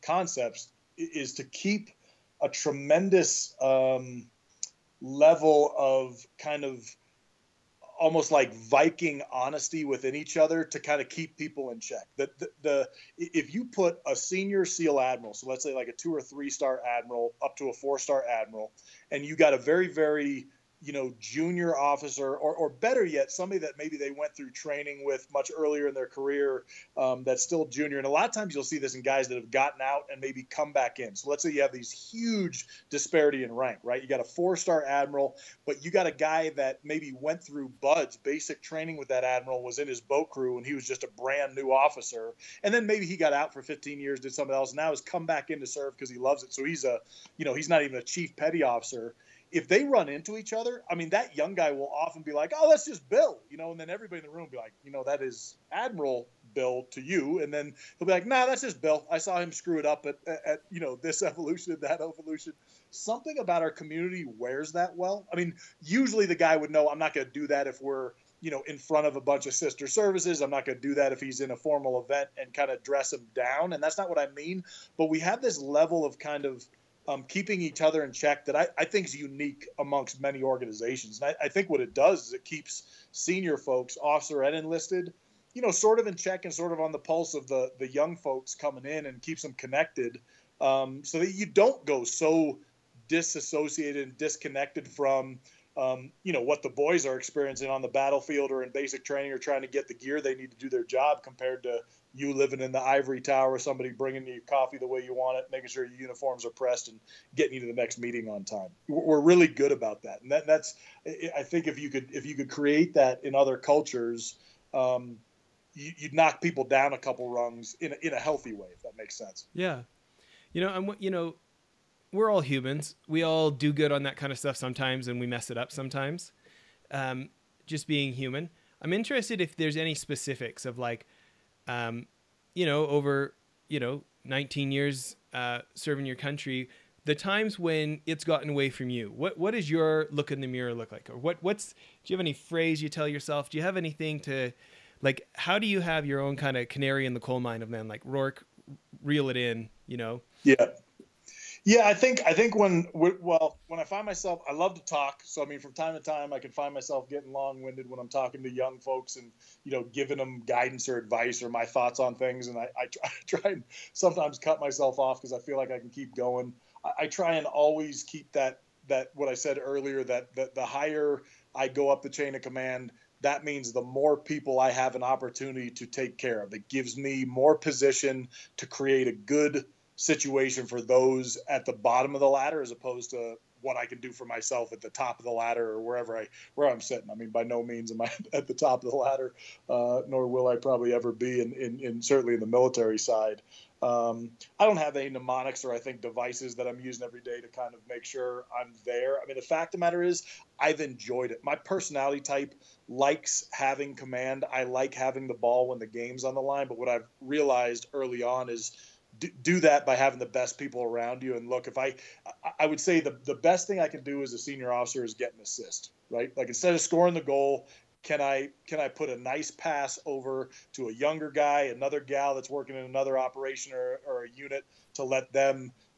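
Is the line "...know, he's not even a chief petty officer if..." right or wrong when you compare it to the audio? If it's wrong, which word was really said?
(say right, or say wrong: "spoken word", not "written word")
right.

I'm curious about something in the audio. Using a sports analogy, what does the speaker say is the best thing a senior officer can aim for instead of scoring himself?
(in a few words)
An assist.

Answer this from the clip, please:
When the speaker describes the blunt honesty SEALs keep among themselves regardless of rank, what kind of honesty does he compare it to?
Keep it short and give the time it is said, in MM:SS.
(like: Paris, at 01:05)
Viking honesty, at 00:08.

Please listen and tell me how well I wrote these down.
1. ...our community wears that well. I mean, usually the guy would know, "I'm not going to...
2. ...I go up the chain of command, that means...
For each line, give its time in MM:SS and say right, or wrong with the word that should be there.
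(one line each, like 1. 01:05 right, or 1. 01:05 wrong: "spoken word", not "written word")
1. 01:03 right
2. 02:51 right.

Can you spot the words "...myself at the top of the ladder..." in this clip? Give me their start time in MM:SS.
03:04.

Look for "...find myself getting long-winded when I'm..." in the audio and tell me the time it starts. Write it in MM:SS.
02:36.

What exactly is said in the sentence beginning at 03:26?
But what I've realized early on is do, that by having the best people around you.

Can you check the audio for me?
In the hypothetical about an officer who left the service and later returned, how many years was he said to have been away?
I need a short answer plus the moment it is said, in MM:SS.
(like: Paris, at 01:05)
15, at 00:43.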